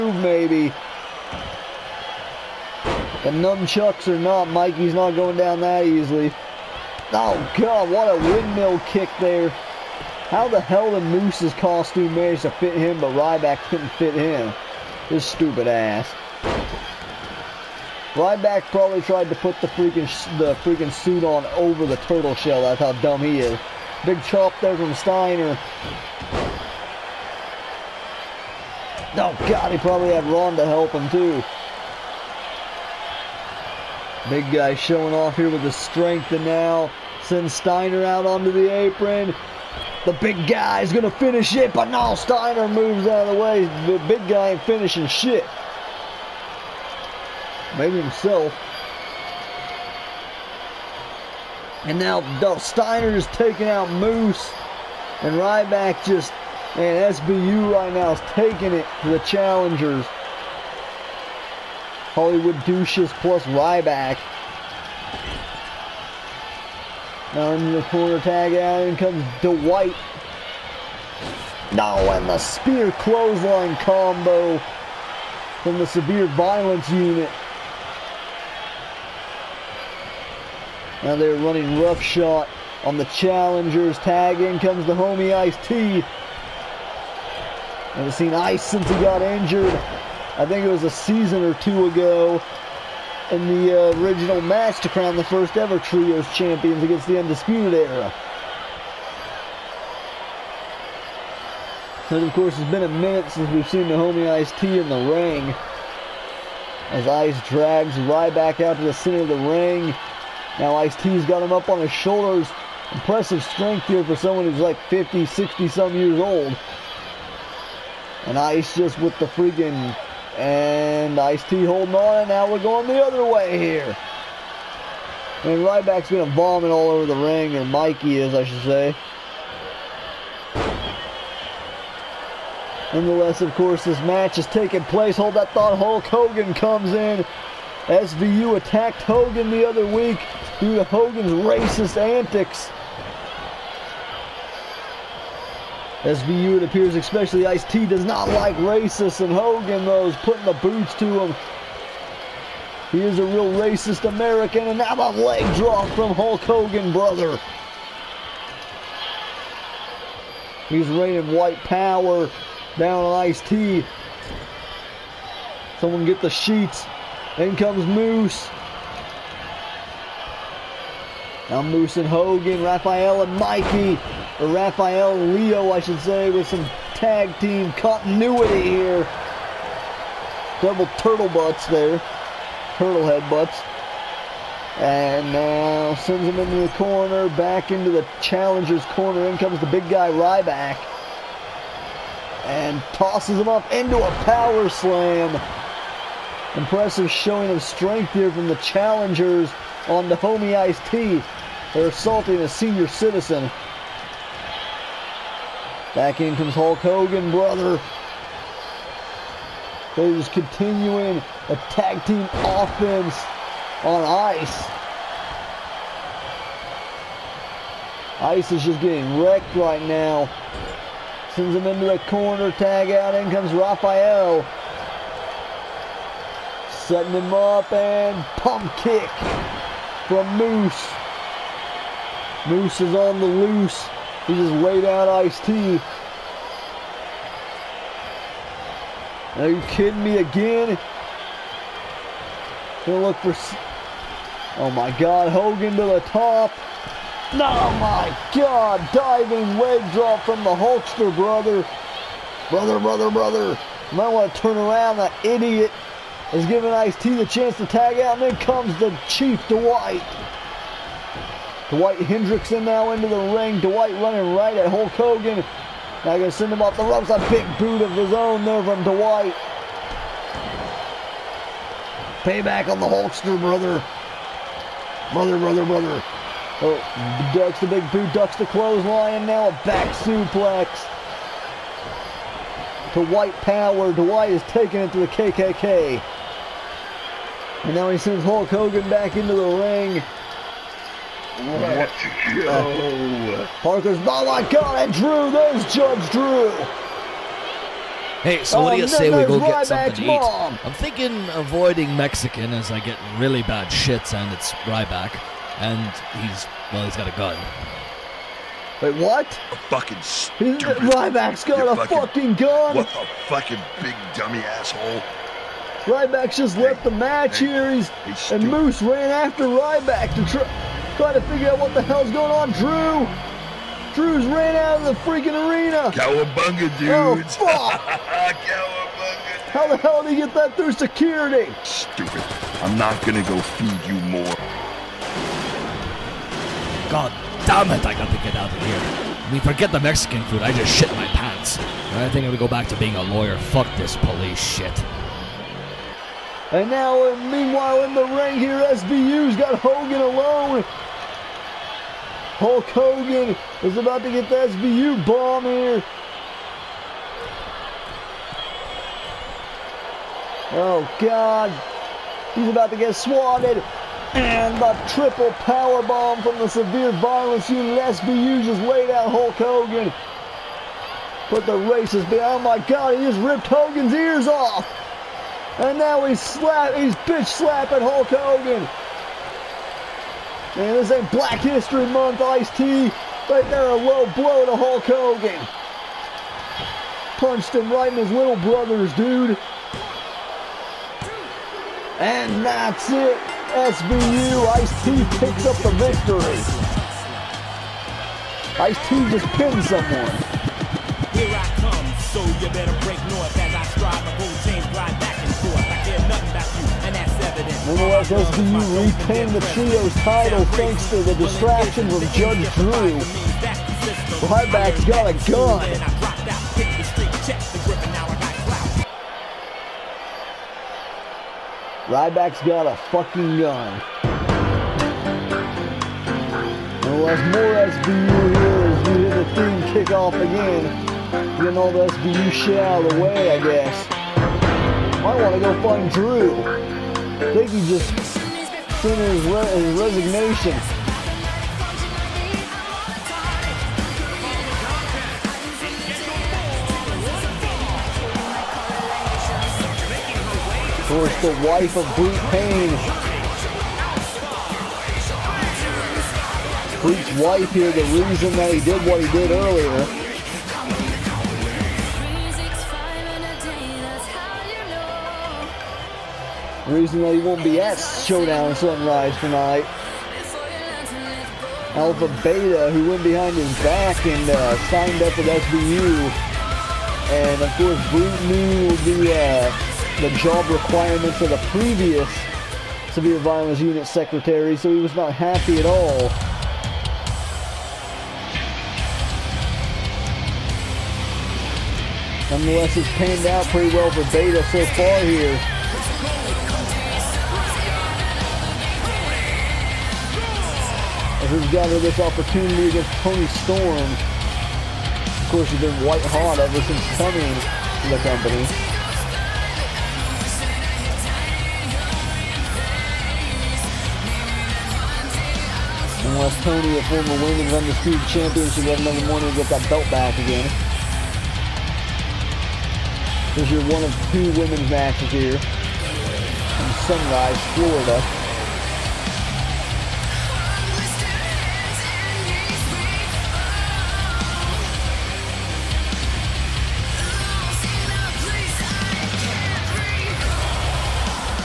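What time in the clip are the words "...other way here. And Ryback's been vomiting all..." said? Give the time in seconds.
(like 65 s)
123 s.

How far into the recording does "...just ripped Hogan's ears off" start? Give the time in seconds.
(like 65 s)
373 s.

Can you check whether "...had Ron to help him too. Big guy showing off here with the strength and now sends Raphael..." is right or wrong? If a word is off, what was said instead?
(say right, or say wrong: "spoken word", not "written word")
wrong: "Steiner", not "Raphael".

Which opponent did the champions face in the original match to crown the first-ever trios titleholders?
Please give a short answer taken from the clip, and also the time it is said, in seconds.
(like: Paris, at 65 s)
Undisputed Era, at 97 s.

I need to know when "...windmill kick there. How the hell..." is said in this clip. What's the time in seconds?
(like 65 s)
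8 s.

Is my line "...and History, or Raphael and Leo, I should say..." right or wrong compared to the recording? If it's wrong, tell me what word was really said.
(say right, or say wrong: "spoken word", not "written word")
wrong: "Mikey", not "History".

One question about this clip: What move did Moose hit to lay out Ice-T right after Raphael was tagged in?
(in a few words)
Pump kick.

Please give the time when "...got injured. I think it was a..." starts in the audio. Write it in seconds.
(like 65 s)
88 s.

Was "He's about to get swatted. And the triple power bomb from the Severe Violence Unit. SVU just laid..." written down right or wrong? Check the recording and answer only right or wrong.
right.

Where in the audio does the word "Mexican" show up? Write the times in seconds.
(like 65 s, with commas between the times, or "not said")
301 s, 339 s.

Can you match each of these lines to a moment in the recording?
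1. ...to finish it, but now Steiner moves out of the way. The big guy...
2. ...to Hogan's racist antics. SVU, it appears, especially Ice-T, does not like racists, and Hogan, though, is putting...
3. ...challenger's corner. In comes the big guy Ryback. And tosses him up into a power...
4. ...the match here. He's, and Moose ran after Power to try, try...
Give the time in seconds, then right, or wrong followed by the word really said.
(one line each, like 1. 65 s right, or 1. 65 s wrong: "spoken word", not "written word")
1. 41 s right
2. 140 s right
3. 188 s right
4. 316 s wrong: "Ryback", not "Power".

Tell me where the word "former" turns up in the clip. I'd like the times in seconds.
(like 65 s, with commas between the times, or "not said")
516 s.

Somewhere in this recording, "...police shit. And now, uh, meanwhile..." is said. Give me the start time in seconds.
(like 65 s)
343 s.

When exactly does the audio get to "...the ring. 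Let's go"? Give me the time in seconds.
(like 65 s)
289 s.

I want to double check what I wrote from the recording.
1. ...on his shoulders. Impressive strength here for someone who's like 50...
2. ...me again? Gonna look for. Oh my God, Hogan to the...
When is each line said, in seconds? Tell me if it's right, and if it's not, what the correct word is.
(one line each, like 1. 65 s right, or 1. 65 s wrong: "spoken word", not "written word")
1. 111 s right
2. 240 s right.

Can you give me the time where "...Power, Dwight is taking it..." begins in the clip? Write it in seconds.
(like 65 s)
283 s.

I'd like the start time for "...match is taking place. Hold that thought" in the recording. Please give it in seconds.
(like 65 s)
134 s.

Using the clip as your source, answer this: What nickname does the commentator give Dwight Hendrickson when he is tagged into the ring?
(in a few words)
The Chief.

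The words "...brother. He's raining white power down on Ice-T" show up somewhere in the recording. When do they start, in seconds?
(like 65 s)
156 s.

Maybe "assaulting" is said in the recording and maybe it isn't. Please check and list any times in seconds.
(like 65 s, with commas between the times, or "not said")
201 s.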